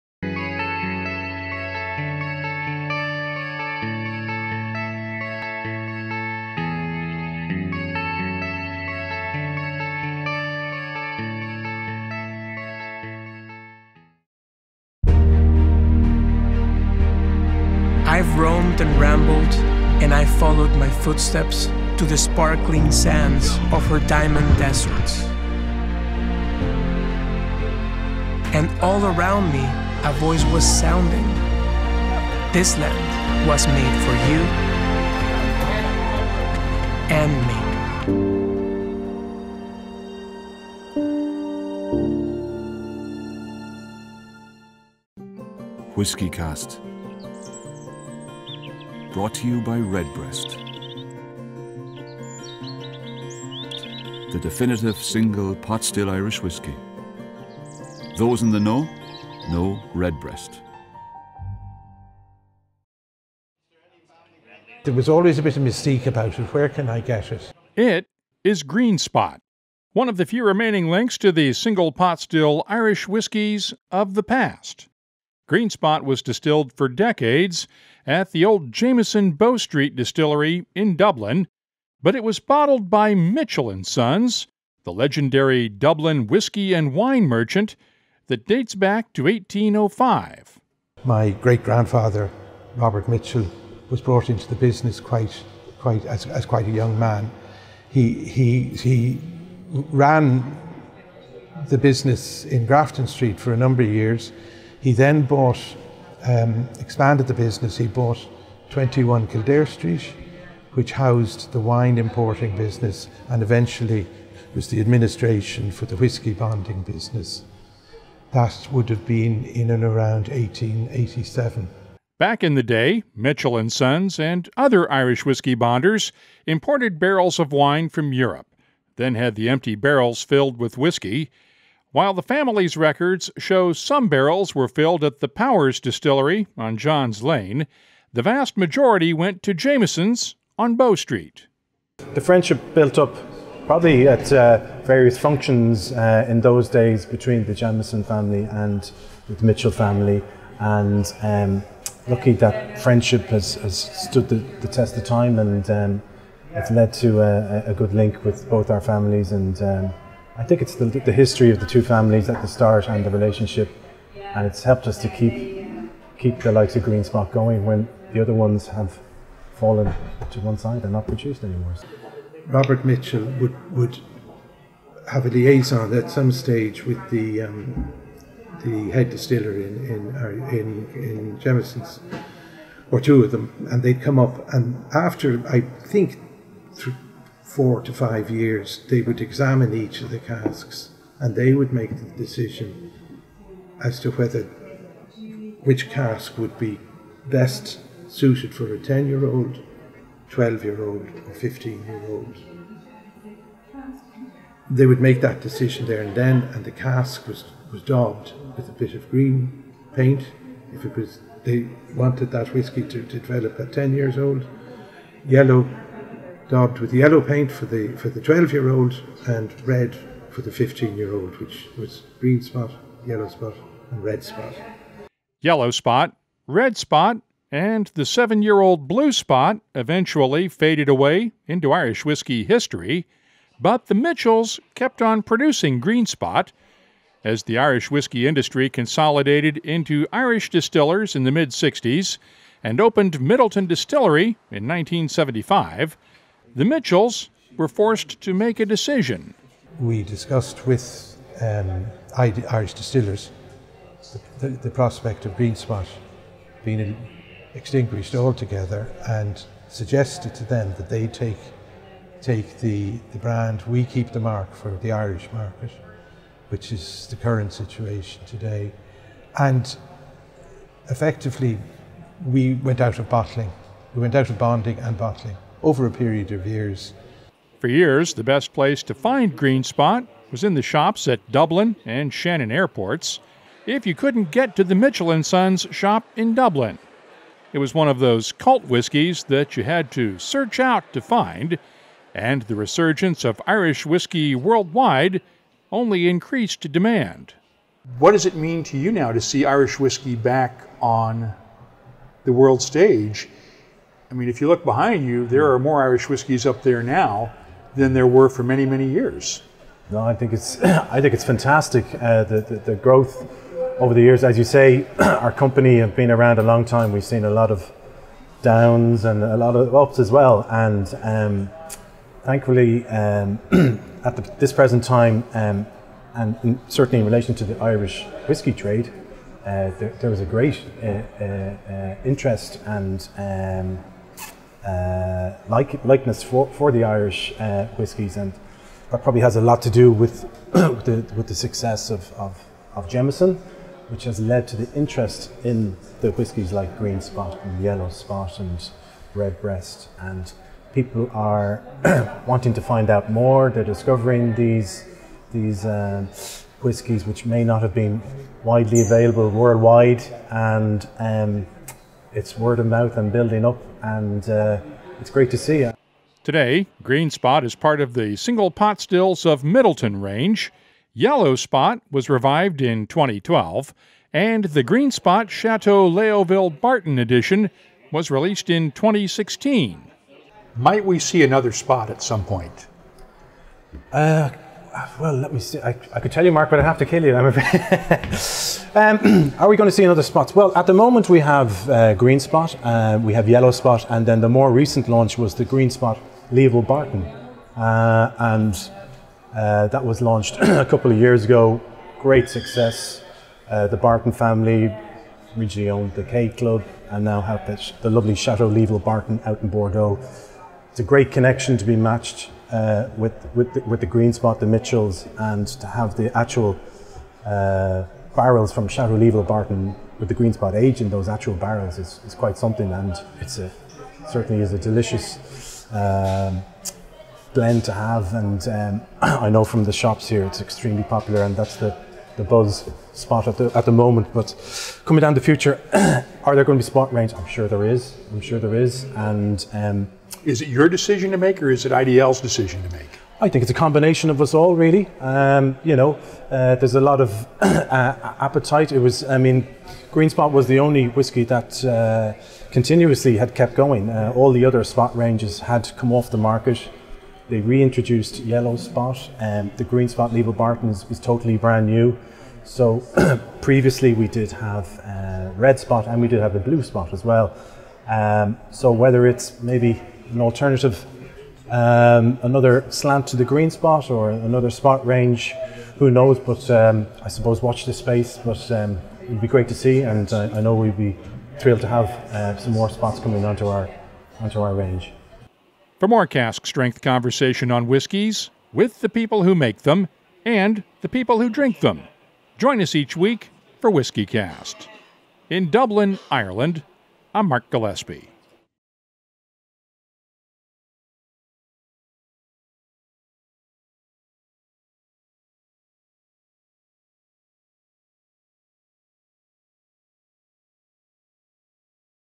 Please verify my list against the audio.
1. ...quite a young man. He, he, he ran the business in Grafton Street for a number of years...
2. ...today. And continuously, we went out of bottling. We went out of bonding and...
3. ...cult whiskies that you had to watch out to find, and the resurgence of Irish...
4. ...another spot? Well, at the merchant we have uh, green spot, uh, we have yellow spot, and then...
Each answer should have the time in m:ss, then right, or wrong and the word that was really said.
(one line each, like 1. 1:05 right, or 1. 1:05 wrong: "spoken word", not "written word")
1. 1:36 right
2. 4:28 wrong: "effectively", not "continuously"
3. 4:48 wrong: "search", not "watch"
4. 6:29 wrong: "moment", not "merchant".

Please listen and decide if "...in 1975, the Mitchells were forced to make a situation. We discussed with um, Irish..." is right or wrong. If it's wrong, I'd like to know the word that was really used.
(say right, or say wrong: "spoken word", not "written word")
wrong: "decision", not "situation".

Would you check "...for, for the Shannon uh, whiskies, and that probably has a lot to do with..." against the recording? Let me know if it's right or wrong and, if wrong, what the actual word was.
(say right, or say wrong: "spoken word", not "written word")
wrong: "Irish", not "Shannon".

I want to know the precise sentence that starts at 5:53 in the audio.
They're discovering these, these uh, whiskies which may not have been widely available worldwide.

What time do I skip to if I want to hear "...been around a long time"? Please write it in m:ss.
5:15.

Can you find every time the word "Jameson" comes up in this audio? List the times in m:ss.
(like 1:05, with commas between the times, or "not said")
1:18, 2:19, 2:27, 3:01.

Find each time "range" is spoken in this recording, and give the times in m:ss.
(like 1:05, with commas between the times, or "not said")
6:10, 7:16, 7:34, 7:54, 8:04.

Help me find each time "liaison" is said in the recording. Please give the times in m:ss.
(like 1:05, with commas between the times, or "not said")
2:55.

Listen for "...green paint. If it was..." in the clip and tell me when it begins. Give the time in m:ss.
3:29.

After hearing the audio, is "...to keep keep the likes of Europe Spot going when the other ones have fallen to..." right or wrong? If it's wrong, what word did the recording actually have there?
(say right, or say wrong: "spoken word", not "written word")
wrong: "Green", not "Europe".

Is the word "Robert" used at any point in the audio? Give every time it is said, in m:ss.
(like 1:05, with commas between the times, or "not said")
1:32, 2:52.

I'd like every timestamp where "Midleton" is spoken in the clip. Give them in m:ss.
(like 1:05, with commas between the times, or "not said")
4:03, 6:09.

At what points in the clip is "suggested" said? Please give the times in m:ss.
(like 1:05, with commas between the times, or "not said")
4:19.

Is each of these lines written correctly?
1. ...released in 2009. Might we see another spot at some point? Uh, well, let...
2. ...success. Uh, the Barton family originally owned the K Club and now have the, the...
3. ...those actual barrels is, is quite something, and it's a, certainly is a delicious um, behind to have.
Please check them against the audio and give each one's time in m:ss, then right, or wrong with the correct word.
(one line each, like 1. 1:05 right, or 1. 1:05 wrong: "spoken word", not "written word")
1. 6:18 wrong: "2016", not "2009"
2. 6:42 right
3. 7:00 wrong: "blend", not "behind".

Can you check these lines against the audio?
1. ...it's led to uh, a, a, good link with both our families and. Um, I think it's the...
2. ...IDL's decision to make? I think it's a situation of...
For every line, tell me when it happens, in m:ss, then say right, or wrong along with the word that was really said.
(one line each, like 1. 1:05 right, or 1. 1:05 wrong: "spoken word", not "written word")
1. 2:36 right
2. 7:21 wrong: "combination", not "situation".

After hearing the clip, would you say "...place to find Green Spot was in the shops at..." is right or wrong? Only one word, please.
right.